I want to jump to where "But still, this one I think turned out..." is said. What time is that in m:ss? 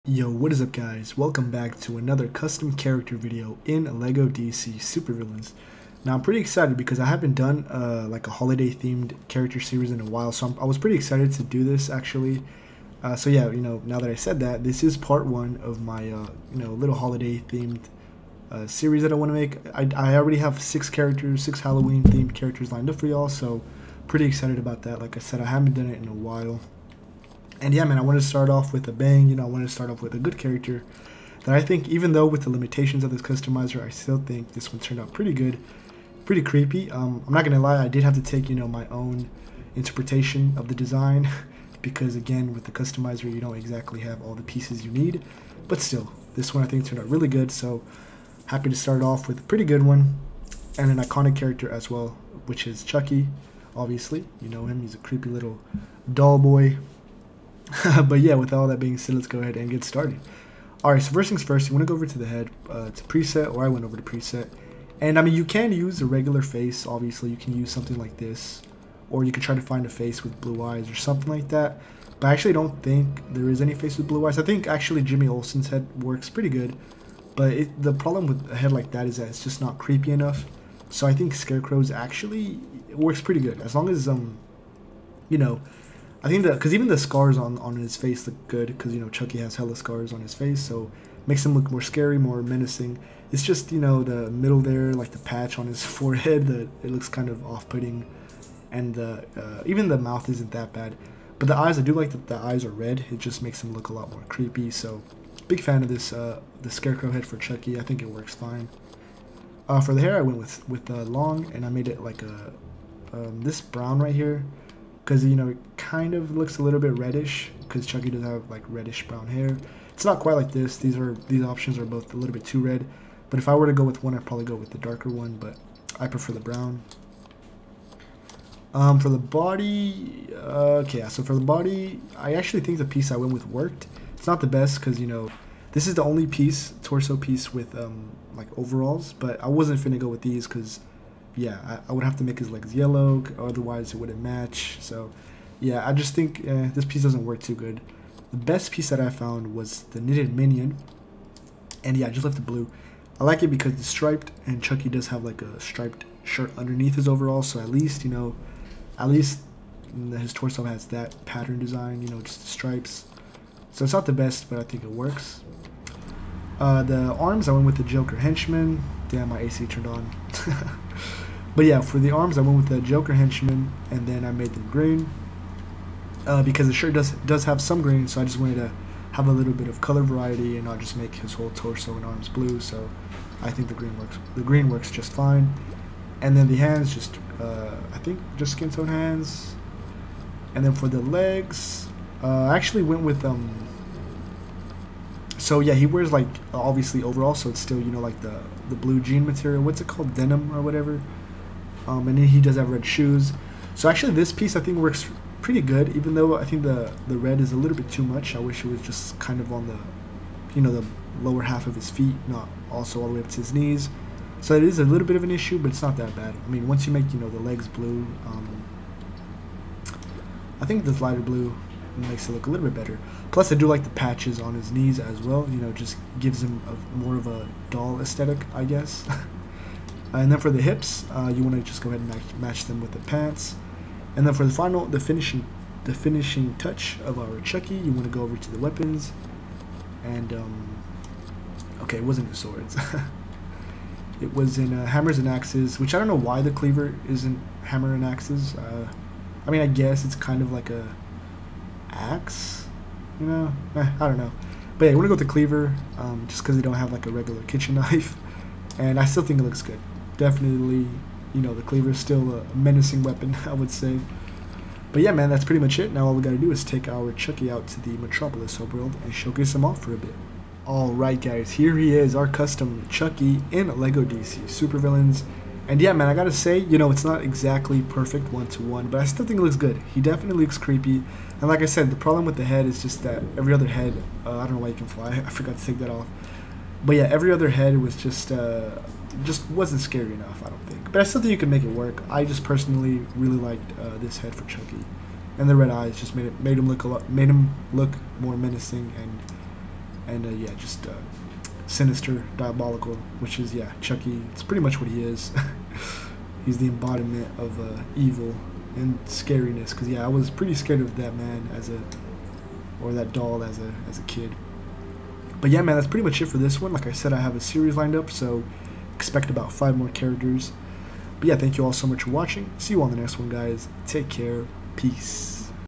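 0:45.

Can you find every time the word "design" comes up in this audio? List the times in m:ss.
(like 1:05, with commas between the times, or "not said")
0:40, 2:41.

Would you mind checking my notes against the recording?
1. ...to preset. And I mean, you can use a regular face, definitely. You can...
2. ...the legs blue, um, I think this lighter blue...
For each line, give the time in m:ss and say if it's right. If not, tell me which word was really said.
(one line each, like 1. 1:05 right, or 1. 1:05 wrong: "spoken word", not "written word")
1. 1:03 wrong: "obviously", not "definitely"
2. 3:37 right.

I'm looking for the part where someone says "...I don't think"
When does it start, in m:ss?
4:50.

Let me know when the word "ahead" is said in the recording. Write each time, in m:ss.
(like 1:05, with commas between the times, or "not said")
0:59, 3:51.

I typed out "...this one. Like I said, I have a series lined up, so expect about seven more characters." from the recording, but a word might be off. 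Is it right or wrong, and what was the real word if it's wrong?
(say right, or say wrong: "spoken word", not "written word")
wrong: "five", not "seven".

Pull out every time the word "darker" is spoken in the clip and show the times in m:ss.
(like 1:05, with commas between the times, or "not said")
2:04.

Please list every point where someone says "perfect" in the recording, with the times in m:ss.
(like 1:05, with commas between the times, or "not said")
4:37.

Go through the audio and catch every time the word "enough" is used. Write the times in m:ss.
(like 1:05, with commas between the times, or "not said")
1:20, 4:50.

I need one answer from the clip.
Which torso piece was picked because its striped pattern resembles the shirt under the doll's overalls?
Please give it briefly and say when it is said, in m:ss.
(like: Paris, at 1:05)
knitted minion, at 2:30.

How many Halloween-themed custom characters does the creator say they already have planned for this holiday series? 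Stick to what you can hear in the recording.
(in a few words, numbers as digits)
6.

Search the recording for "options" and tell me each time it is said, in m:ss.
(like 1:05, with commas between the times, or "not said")
2:01.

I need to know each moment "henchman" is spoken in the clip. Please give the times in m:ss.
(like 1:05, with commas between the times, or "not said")
2:48, 2:53.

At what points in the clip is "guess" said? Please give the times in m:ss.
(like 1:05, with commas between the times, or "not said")
3:48, 4:09.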